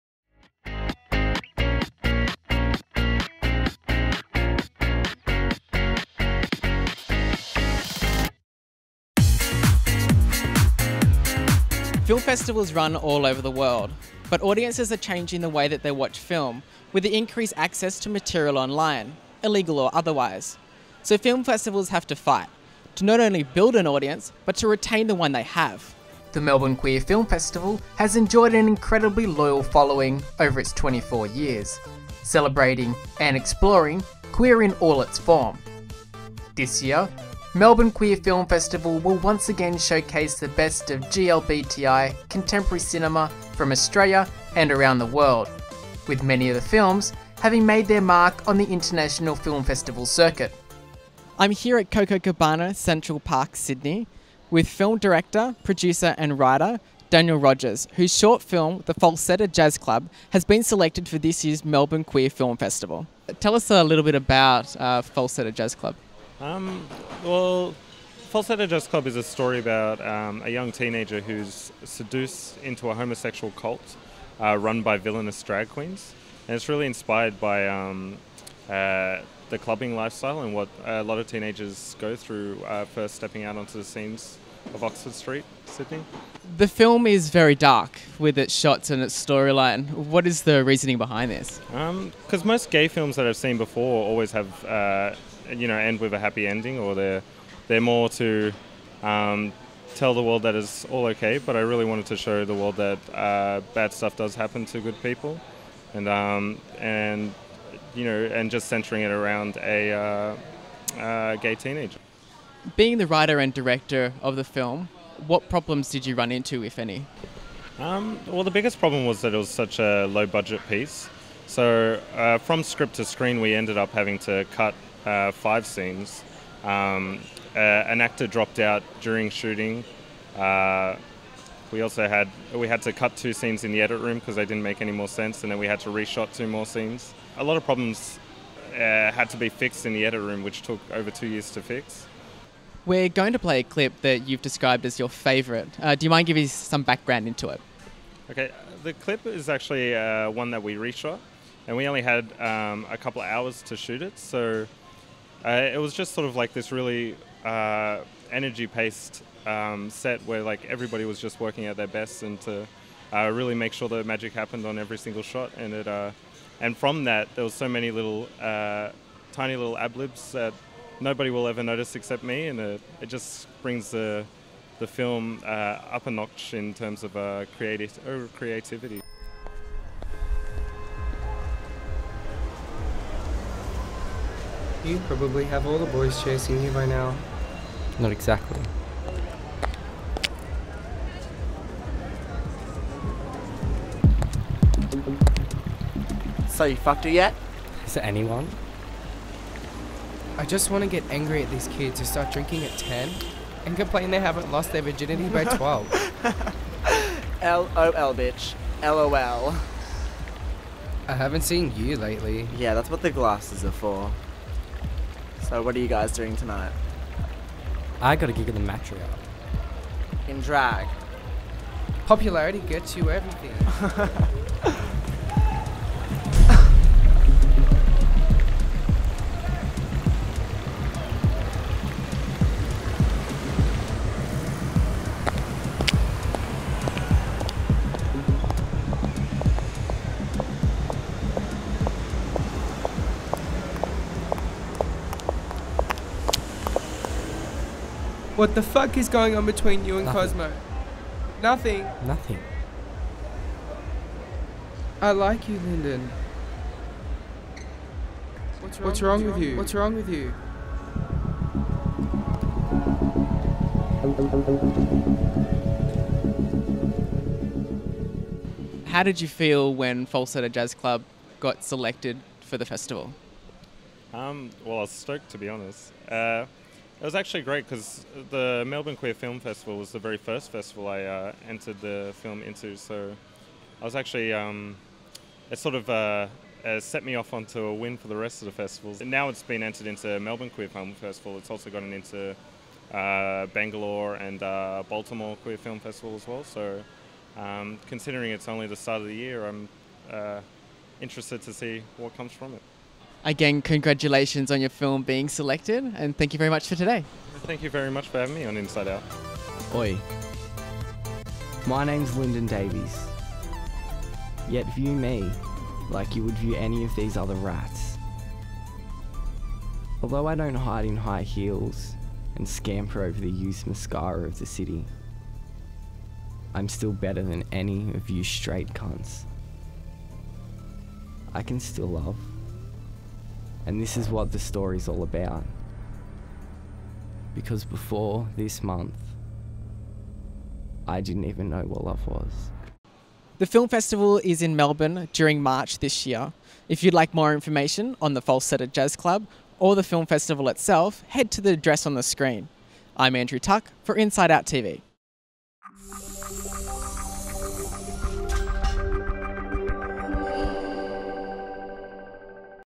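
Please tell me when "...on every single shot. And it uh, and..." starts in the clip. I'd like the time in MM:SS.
02:44.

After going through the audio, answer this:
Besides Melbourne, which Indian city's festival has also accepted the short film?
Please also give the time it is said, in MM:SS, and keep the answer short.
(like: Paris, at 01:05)
Bangalore, at 04:53.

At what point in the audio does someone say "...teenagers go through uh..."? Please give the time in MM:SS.
01:21.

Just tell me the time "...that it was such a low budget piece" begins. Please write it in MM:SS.
01:59.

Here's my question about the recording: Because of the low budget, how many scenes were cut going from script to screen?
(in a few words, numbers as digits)
5.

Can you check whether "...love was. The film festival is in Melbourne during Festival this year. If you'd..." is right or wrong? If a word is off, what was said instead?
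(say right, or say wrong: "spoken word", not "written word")
wrong: "March", not "Festival".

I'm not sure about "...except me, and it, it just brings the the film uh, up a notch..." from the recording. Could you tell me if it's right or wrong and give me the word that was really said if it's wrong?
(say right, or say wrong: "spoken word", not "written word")
right.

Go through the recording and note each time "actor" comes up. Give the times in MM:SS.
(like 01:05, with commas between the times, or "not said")
02:08.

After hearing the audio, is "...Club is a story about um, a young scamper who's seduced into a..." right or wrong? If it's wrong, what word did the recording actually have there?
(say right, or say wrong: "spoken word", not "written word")
wrong: "teenager", not "scamper".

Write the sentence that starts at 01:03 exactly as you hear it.
Tell us a little bit about uh, Falsetto Jazz Club.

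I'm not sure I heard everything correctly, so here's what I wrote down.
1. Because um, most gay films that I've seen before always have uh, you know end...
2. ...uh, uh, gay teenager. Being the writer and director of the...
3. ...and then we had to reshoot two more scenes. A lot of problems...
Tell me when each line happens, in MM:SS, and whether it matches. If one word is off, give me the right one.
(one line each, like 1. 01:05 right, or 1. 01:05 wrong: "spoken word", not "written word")
1. 01:31 right
2. 01:49 right
3. 02:15 right.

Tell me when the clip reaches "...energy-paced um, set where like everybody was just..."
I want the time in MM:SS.
02:38.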